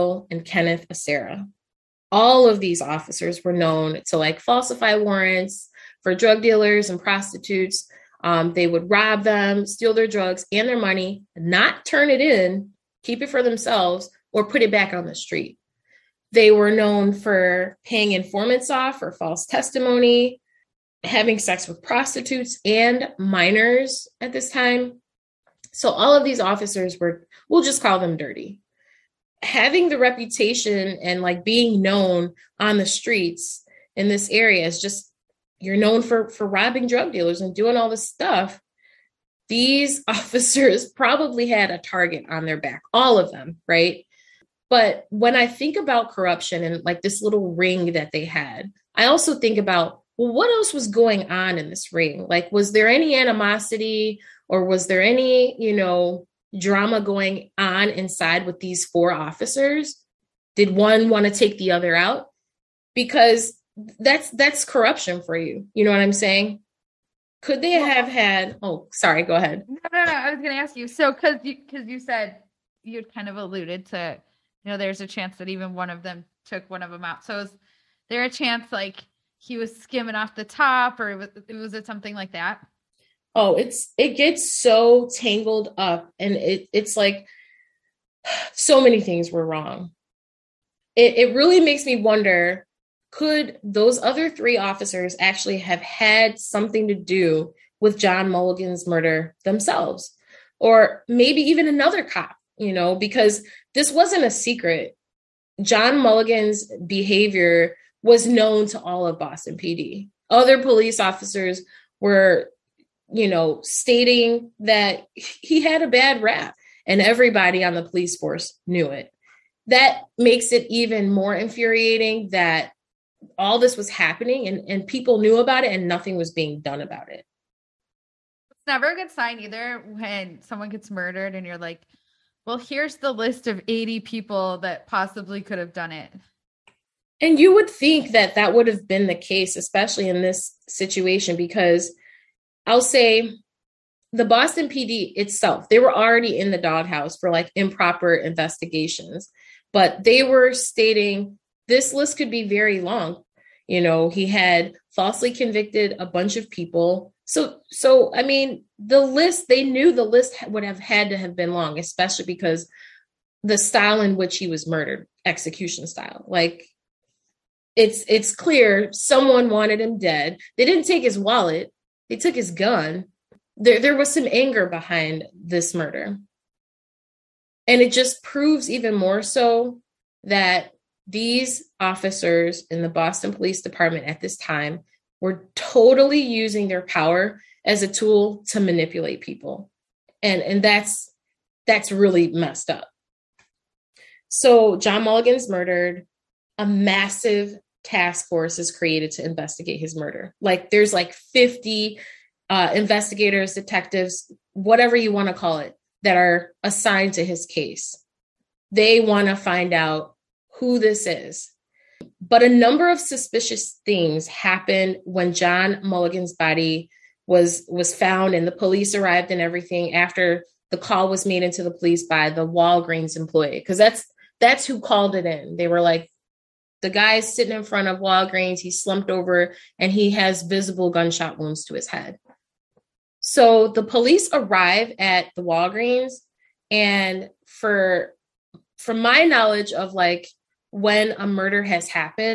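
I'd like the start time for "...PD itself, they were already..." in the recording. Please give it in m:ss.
2:24.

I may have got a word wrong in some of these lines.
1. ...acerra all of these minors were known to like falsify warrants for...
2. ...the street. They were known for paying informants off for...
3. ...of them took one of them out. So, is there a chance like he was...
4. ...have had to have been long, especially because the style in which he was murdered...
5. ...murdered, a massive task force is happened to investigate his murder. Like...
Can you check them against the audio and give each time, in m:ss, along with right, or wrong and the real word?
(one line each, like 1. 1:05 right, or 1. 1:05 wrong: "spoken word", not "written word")
1. 0:00 wrong: "officers", not "minors"
2. 0:15 right
3. 1:15 right
4. 2:40 right
5. 3:15 wrong: "created", not "happened".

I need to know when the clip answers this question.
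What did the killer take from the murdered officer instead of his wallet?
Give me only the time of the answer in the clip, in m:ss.
2:52.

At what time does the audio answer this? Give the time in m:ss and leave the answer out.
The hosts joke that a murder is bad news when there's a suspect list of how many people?
2:13.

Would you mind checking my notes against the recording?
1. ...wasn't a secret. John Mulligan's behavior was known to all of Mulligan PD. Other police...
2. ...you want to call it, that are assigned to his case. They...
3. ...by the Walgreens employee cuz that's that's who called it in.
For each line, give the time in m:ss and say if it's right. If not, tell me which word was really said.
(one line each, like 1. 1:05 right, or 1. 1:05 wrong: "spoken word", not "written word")
1. 1:43 wrong: "Boston", not "Mulligan"
2. 3:24 right
3. 3:42 right.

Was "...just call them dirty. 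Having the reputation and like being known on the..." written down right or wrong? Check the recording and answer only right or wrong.
right.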